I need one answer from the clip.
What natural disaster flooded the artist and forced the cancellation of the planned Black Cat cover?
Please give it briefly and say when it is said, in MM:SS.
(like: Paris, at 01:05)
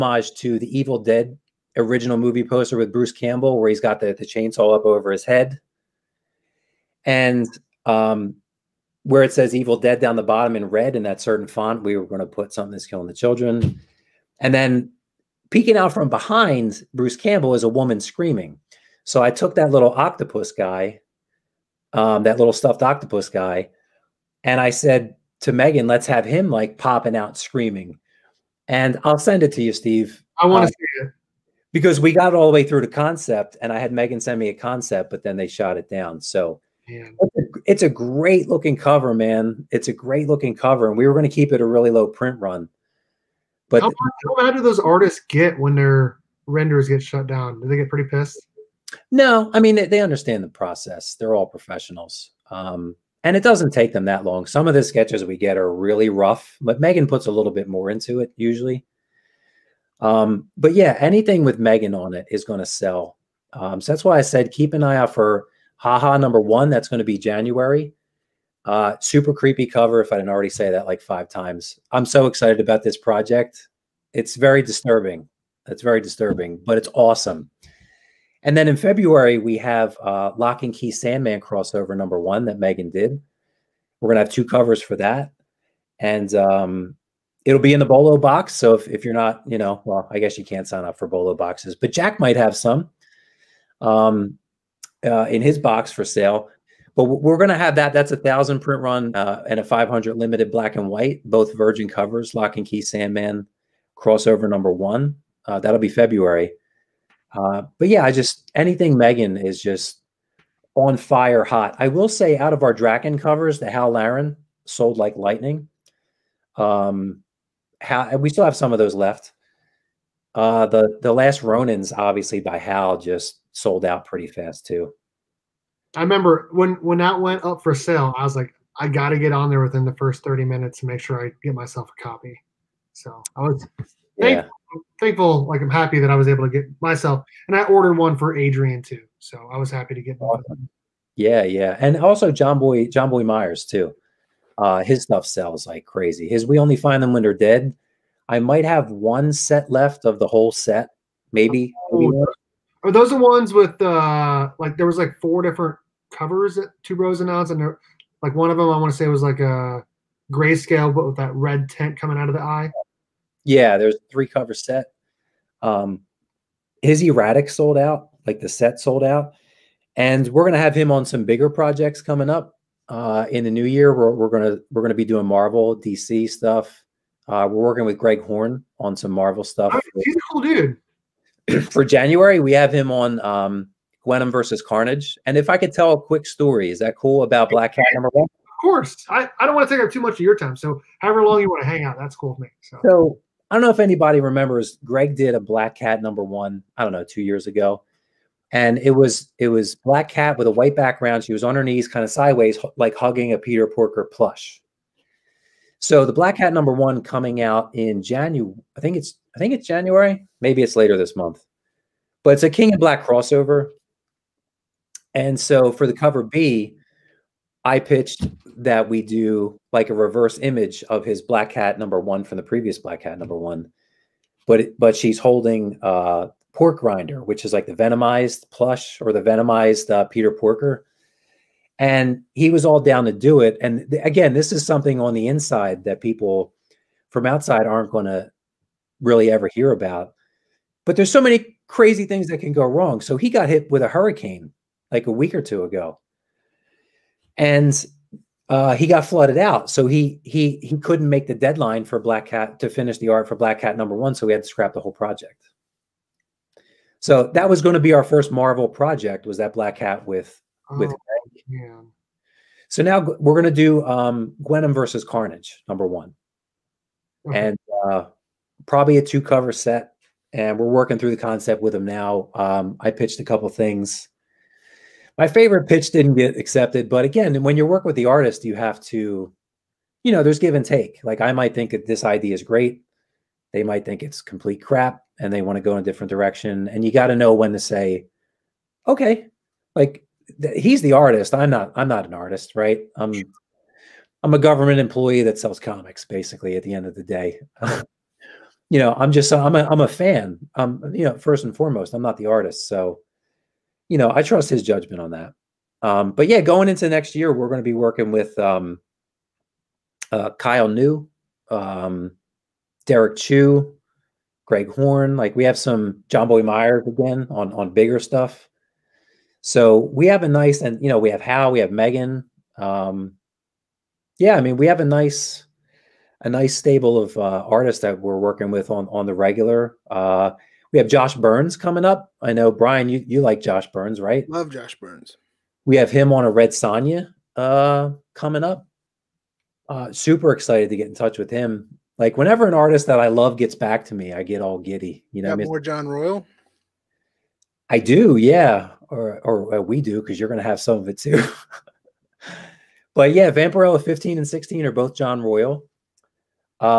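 a hurricane, at 04:03.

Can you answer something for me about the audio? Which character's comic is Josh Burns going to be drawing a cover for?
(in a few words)
Red Sonja.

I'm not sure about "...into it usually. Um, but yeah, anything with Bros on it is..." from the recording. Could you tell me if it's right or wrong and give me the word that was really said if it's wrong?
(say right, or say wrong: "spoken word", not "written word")
wrong: "Megan", not "Bros".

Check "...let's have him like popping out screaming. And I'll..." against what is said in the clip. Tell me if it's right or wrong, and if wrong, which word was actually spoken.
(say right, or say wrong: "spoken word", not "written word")
right.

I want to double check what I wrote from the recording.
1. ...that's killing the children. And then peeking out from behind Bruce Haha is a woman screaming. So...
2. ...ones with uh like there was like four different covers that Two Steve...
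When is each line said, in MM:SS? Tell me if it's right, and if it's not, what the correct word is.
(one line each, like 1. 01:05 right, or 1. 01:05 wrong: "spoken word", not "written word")
1. 00:12 wrong: "Campbell", not "Haha"
2. 02:33 wrong: "Bros", not "Steve".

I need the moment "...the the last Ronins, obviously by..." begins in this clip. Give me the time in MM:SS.
02:00.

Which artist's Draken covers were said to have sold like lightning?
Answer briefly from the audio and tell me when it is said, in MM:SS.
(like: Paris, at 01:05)
Hal Laren, at 01:53.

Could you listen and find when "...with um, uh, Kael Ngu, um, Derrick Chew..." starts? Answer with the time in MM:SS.
05:08.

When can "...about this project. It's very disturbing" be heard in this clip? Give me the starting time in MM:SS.
01:12.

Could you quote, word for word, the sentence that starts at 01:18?
And then in February, we have uh, Locke and Key Sandman crossover number one that Megan did.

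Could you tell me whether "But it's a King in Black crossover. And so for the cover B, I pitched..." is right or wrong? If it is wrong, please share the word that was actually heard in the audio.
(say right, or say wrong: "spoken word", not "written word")
right.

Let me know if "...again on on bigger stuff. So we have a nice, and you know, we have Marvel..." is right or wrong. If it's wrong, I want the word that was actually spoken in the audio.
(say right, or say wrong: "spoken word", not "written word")
wrong: "Hal", not "Marvel".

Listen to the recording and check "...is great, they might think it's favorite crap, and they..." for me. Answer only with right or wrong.
wrong.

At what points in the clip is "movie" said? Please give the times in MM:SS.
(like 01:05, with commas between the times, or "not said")
00:02.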